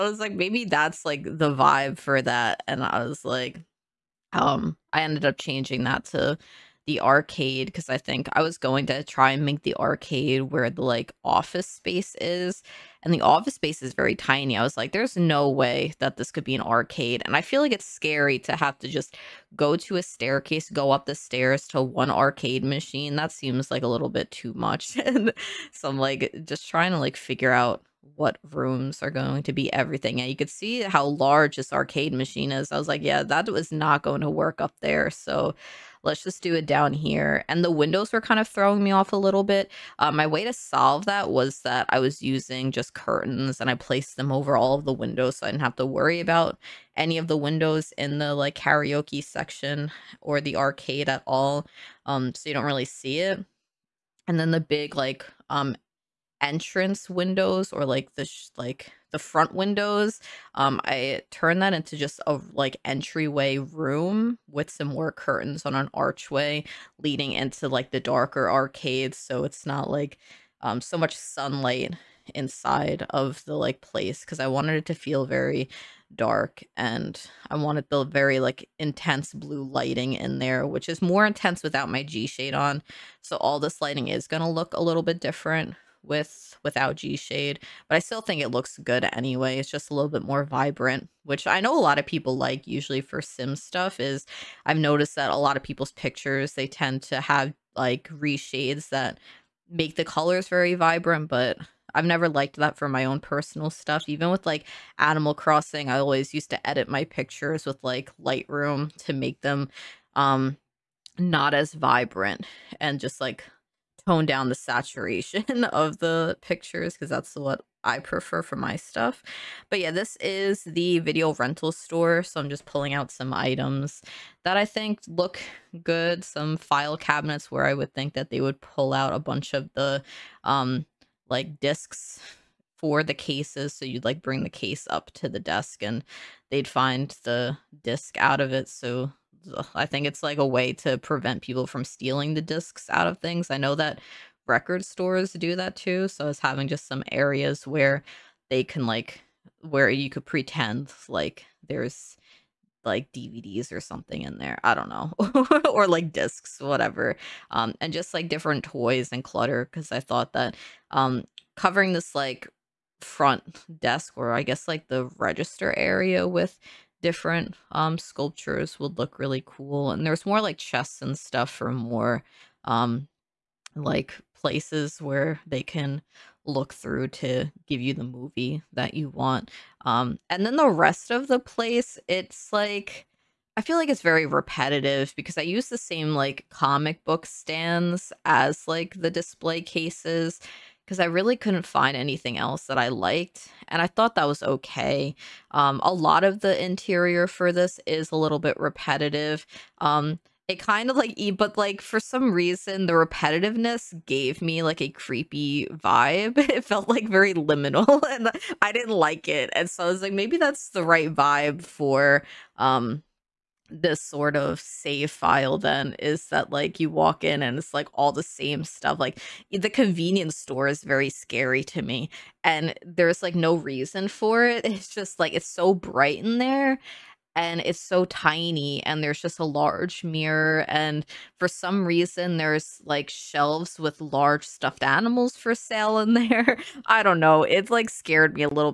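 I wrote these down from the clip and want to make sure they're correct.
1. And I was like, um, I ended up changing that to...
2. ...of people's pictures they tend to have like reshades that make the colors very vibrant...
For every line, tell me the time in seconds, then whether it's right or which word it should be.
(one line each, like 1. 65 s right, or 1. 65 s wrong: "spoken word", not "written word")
1. 2 s right
2. 95 s right.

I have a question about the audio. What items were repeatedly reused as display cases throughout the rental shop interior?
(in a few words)
Comic book stands.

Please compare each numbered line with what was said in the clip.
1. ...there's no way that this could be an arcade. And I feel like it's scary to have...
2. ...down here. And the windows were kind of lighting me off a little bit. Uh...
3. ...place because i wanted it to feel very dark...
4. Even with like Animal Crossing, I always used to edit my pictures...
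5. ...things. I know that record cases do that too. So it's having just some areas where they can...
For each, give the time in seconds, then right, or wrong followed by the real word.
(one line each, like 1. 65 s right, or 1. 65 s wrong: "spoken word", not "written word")
1. 14 s right
2. 36 s wrong: "throwing", not "lighting"
3. 73 s right
4. 104 s right
5. 143 s wrong: "stores", not "cases".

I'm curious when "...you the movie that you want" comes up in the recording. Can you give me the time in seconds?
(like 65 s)
177 s.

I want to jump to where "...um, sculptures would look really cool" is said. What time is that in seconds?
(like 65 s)
167 s.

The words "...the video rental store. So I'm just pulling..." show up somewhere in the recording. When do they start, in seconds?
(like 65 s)
120 s.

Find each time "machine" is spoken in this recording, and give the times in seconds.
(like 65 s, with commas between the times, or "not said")
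22 s, 32 s.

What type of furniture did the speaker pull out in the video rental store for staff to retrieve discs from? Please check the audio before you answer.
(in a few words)
File cabinets.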